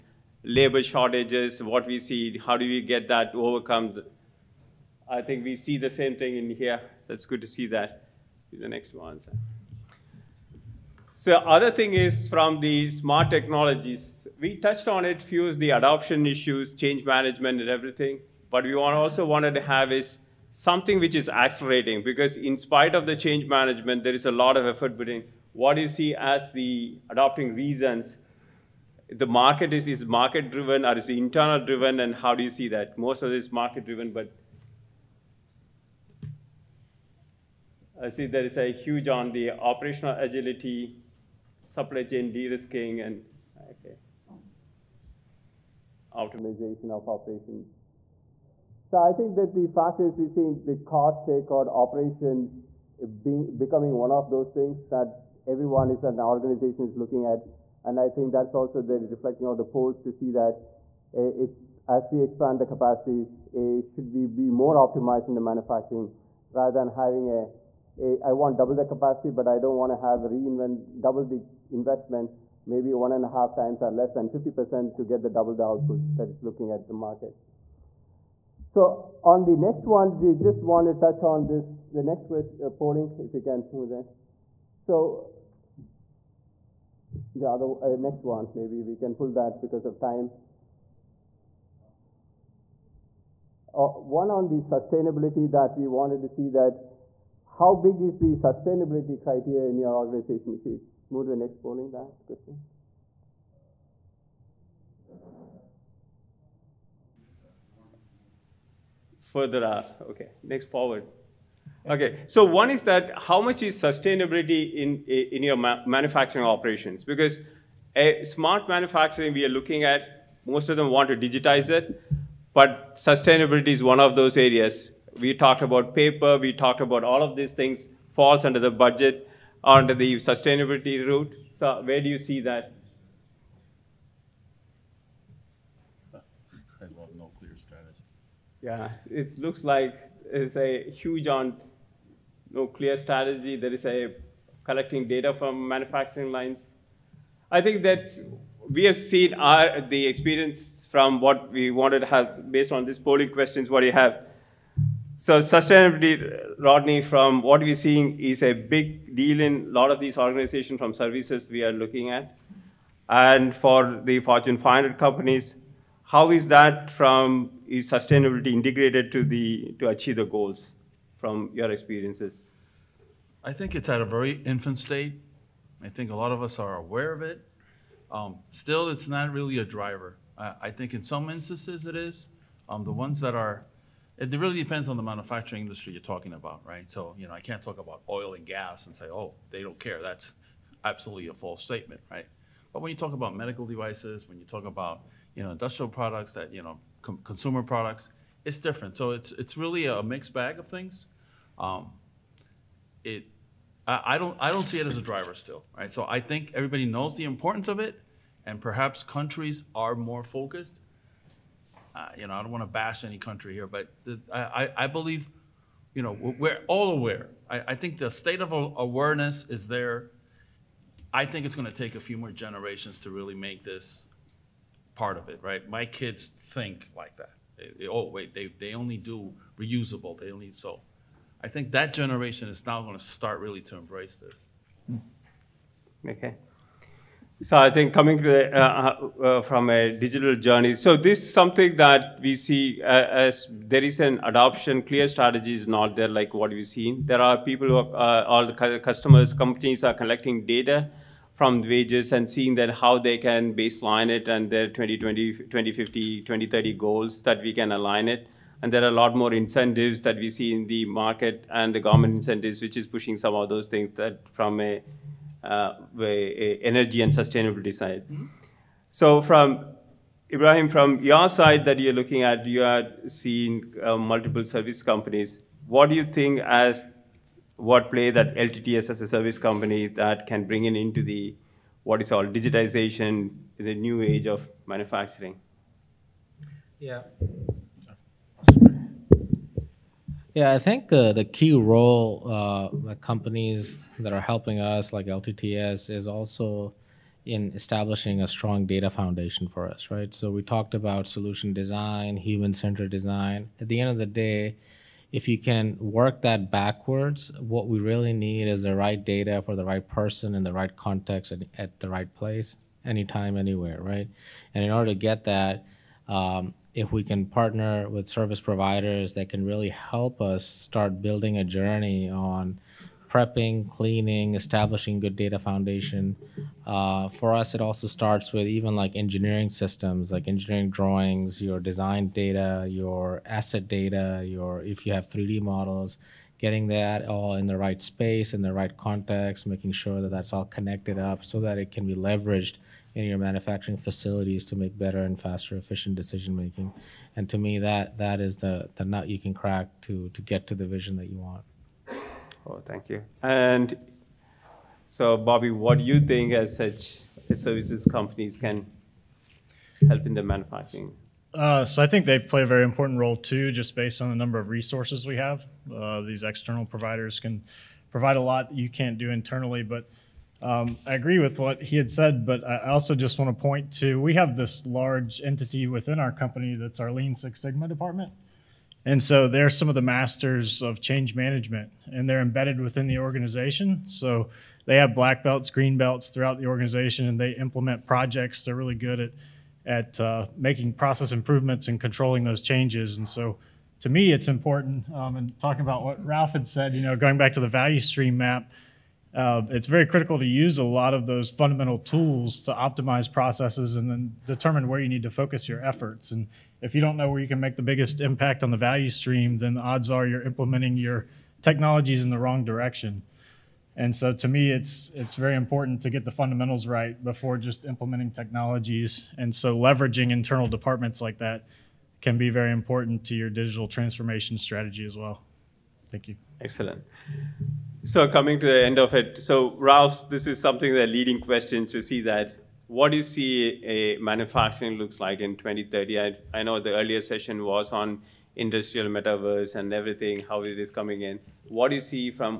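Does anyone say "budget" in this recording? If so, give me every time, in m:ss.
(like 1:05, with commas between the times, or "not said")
2:08.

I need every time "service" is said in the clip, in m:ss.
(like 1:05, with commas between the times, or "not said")
2:40, 4:34, 4:39, 5:18, 5:57.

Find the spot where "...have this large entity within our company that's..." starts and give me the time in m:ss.
6:14.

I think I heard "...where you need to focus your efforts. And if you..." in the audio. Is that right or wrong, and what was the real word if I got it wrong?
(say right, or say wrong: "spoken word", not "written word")
right.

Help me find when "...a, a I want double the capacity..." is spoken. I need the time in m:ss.
1:07.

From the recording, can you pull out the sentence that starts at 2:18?
Yeah, it looks like it's a huge on no clear strategy.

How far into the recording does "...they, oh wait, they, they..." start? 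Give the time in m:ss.
3:47.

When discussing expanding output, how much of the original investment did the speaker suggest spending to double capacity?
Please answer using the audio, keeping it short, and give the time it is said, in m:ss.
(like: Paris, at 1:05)
1.5 times, at 1:12.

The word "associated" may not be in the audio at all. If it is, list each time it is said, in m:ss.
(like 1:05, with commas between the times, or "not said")
not said.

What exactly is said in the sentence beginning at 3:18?
So it's, it's really a mixed bag of things.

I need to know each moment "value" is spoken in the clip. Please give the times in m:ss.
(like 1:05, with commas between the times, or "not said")
6:37, 6:48.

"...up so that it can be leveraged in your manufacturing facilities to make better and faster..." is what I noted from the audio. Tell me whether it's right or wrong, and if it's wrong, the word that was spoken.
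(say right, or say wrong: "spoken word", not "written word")
right.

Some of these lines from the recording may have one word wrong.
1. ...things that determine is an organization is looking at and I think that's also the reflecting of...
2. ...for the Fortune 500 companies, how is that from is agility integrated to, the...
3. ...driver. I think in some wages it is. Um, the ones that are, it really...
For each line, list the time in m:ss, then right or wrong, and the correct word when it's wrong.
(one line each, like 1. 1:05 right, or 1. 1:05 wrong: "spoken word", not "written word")
1. 0:54 wrong: "everyone", not "determine"
2. 2:43 wrong: "sustainability", not "agility"
3. 2:59 wrong: "instances", not "wages".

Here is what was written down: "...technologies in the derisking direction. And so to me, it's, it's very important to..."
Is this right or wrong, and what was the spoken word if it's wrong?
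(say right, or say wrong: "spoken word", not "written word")
wrong: "wrong", not "derisking".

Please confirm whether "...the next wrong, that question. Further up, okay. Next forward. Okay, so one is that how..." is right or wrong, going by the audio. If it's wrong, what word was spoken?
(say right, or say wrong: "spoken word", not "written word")
wrong: "polling", not "wrong".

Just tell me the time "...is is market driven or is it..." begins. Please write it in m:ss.
0:29.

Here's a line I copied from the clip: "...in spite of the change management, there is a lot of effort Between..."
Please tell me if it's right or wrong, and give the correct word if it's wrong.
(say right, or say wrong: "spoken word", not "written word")
right.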